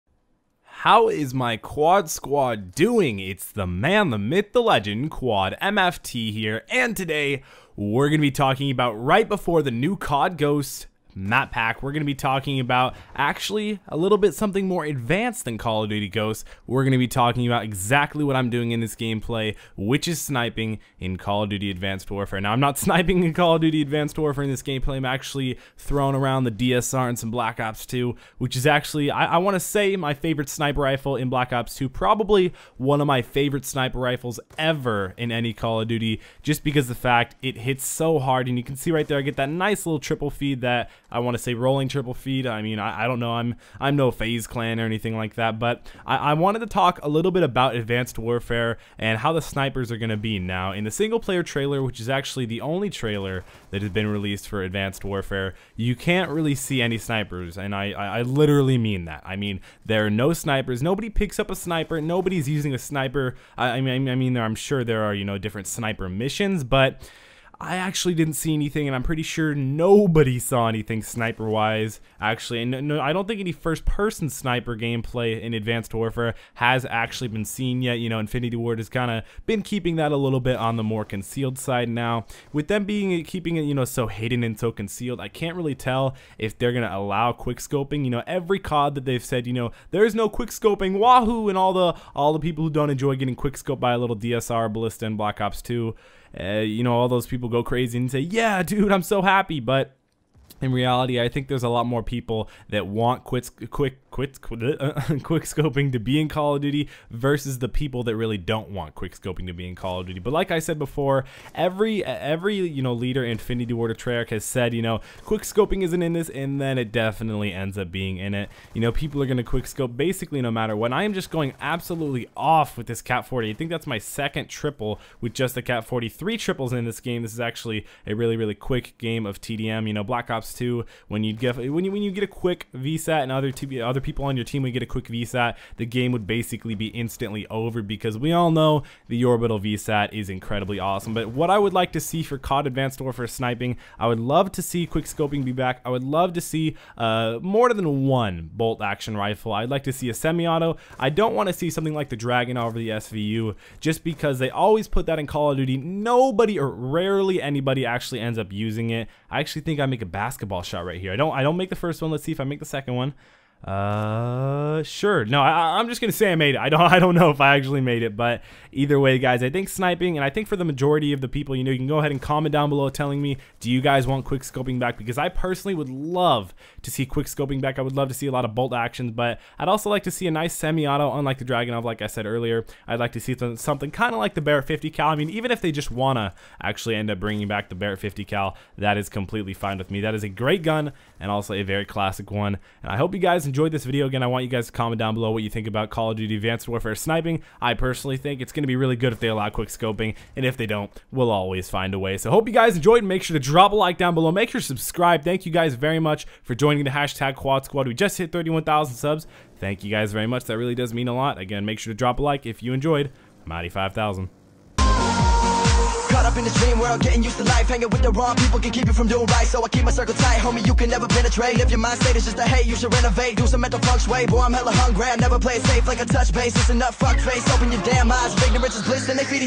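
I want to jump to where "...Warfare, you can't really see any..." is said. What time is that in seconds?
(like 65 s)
55 s.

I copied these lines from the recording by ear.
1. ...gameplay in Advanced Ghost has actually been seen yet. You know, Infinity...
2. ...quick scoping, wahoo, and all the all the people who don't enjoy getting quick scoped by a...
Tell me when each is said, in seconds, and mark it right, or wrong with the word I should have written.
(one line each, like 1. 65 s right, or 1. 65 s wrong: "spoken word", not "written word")
1. 74 s wrong: "Warfare", not "Ghost"
2. 90 s right.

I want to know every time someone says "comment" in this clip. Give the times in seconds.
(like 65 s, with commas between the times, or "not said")
172 s, 194 s.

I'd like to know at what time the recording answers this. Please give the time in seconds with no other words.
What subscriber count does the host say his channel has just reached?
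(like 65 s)
208 s.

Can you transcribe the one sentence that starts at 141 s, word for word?
But what I would like to see for COD Advanced Warfare sniping, I would love to see quick scoping be back.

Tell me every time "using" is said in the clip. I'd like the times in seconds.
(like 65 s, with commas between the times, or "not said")
62 s, 158 s.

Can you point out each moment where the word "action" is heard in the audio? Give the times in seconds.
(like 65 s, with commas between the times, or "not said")
148 s, 178 s.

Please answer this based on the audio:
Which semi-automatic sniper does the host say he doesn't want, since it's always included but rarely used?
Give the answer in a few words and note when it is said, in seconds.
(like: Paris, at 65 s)
Dragunov, at 181 s.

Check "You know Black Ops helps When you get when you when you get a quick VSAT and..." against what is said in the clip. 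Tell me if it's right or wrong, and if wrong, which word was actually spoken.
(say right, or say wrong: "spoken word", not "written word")
right.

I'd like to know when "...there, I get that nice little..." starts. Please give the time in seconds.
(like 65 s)
39 s.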